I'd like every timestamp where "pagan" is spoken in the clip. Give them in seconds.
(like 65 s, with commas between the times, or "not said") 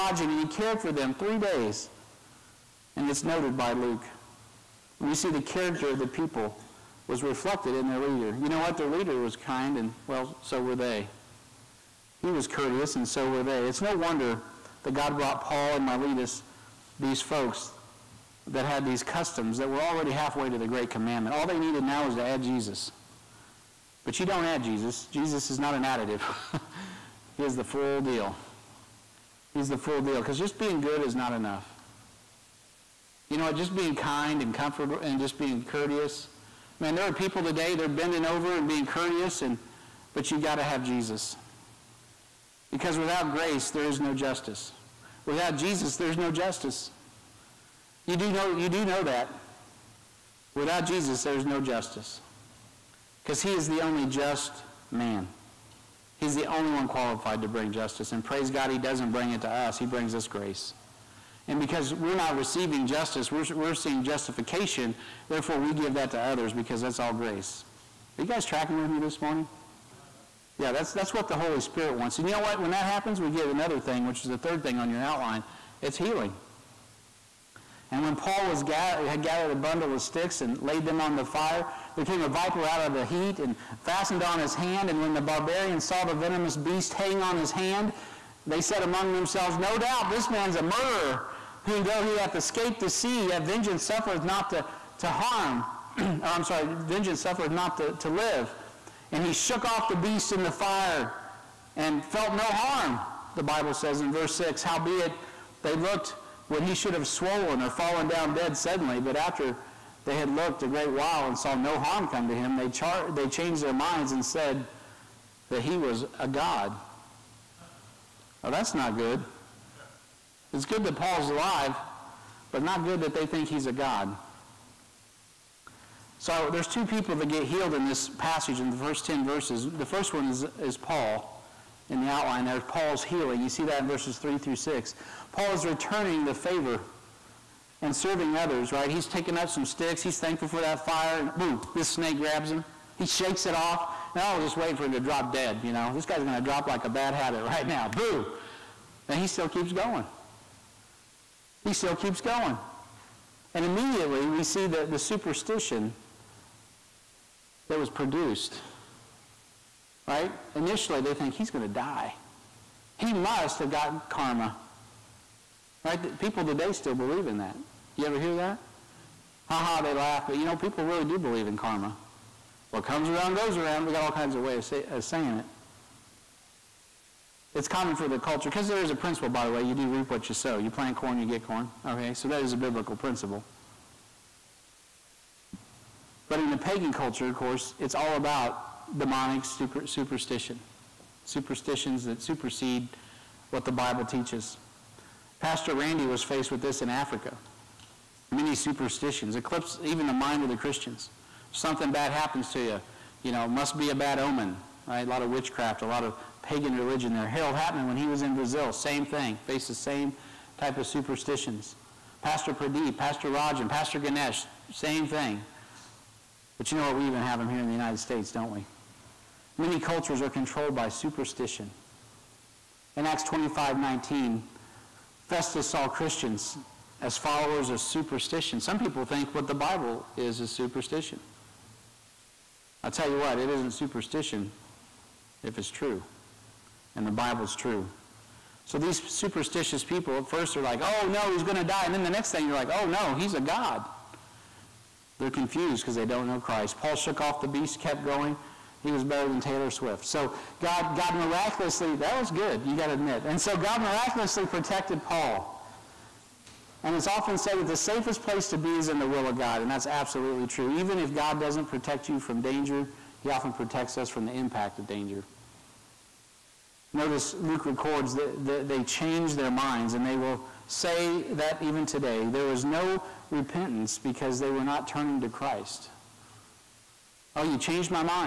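186 s, 206 s.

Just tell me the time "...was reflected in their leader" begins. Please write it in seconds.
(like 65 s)
7 s.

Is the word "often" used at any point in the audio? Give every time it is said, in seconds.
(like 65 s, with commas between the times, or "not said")
257 s, 263 s.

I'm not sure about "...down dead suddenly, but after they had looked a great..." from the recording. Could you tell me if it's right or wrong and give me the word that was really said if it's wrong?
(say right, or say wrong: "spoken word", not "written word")
right.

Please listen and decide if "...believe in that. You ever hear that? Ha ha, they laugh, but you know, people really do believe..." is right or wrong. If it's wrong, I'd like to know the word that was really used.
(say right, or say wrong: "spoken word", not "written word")
right.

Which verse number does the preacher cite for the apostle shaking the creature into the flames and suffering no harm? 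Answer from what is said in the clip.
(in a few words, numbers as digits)
6.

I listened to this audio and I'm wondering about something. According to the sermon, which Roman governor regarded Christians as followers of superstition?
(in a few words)
Festus.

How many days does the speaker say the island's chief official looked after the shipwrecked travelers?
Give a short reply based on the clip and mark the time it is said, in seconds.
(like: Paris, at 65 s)
3, at 1 s.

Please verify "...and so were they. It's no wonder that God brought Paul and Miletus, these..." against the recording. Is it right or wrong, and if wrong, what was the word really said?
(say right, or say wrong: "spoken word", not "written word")
right.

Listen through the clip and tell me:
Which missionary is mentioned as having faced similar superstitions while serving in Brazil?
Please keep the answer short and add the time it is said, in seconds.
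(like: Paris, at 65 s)
Harold Hatman, at 207 s.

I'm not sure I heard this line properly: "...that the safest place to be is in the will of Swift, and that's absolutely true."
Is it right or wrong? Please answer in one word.
wrong.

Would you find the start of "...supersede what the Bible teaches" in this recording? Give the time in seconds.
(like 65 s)
192 s.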